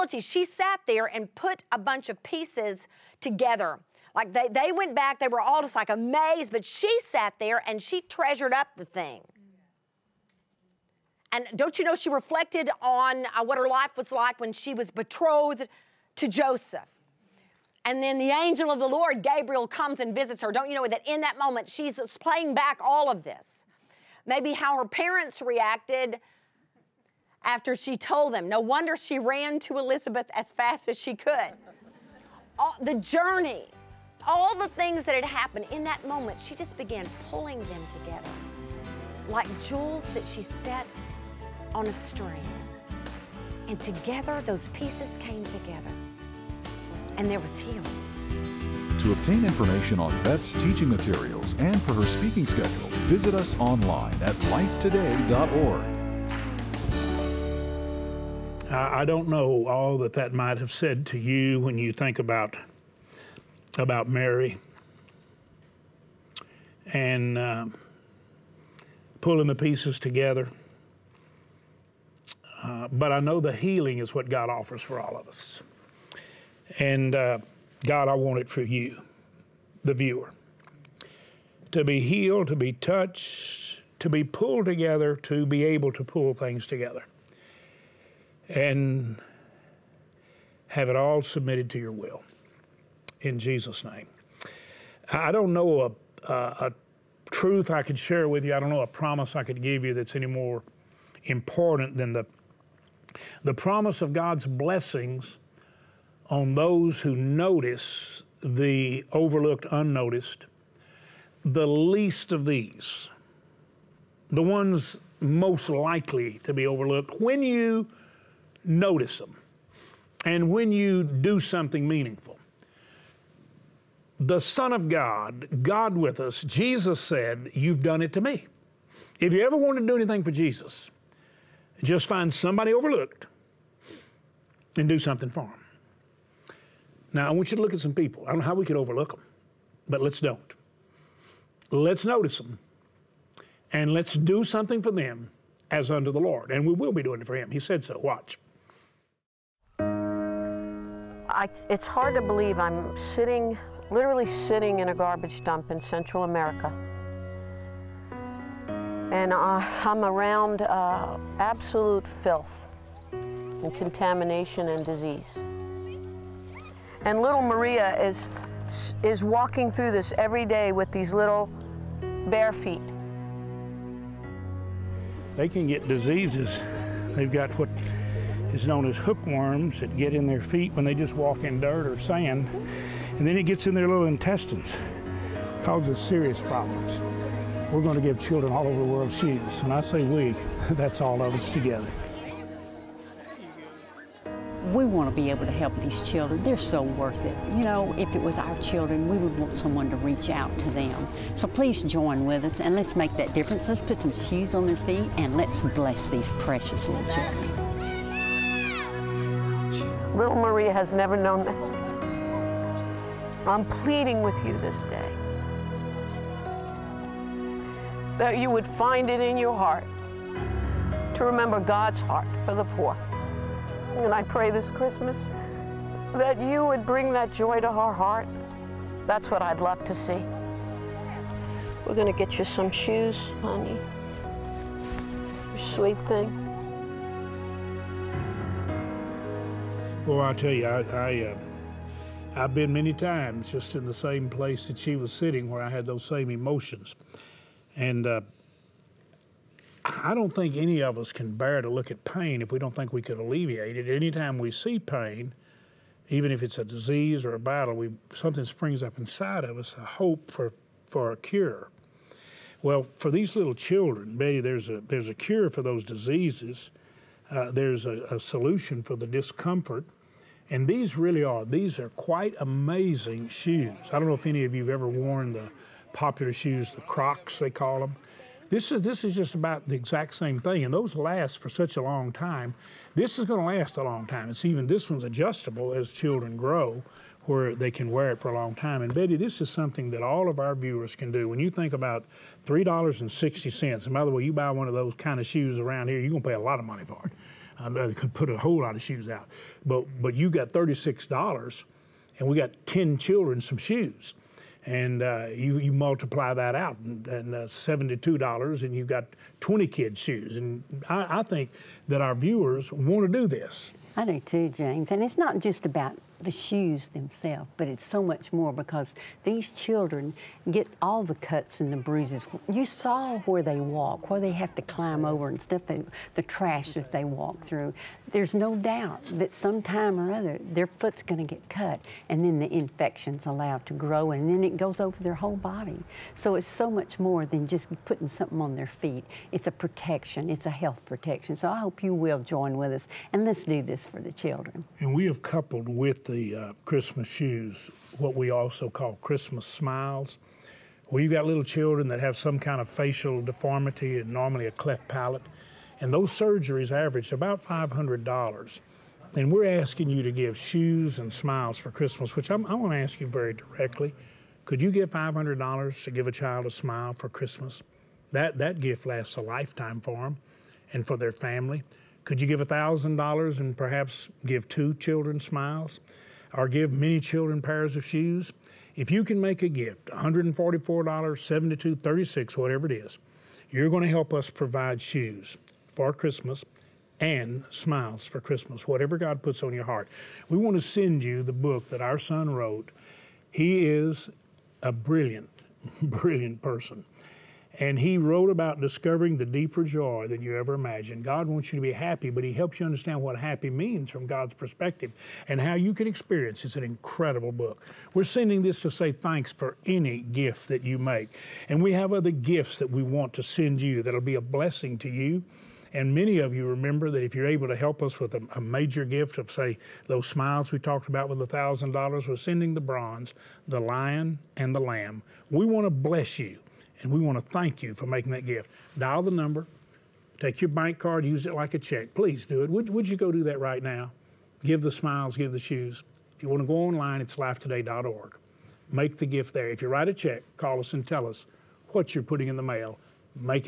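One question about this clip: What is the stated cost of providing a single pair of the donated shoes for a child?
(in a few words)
$3.60.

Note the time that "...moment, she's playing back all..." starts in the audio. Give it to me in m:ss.
0:21.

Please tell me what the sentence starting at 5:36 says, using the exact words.
So it's so much more than just putting something on their feet.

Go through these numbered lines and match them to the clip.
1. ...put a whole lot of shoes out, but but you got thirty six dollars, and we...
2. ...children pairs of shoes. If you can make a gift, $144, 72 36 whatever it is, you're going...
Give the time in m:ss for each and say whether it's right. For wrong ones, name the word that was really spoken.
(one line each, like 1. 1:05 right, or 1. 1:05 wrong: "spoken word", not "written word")
1. 4:58 right
2. 6:16 right.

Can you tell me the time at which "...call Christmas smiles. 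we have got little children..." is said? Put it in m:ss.
5:48.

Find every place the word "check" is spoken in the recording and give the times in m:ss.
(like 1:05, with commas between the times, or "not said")
7:11, 7:19.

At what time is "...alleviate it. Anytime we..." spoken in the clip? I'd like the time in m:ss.
4:13.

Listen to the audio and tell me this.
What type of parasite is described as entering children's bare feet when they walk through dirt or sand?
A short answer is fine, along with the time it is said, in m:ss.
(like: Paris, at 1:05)
Hookworms, at 2:58.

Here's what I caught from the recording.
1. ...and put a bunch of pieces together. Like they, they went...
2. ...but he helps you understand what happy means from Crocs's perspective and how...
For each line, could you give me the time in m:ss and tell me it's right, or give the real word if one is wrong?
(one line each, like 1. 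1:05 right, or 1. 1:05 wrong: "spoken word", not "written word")
1. 0:01 right
2. 6:42 wrong: "God", not "Crocs".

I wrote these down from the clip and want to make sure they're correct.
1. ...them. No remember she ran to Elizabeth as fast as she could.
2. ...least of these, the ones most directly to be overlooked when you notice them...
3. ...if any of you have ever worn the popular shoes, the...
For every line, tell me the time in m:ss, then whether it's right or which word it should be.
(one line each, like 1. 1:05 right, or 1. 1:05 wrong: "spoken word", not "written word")
1. 0:28 wrong: "wonder", not "remember"
2. 1:51 wrong: "likely", not "directly"
3. 4:34 right.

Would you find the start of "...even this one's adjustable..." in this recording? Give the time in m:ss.
4:44.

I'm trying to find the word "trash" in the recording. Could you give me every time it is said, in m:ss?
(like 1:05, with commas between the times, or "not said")
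5:26.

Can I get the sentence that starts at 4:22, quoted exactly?
Well, for these little children, Betty, there's a, there's a cure for those diseases.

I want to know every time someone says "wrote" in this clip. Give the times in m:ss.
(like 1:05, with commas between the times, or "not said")
6:32, 6:37.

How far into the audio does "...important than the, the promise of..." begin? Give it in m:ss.
1:41.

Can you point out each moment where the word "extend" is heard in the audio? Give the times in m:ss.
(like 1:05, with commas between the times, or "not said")
not said.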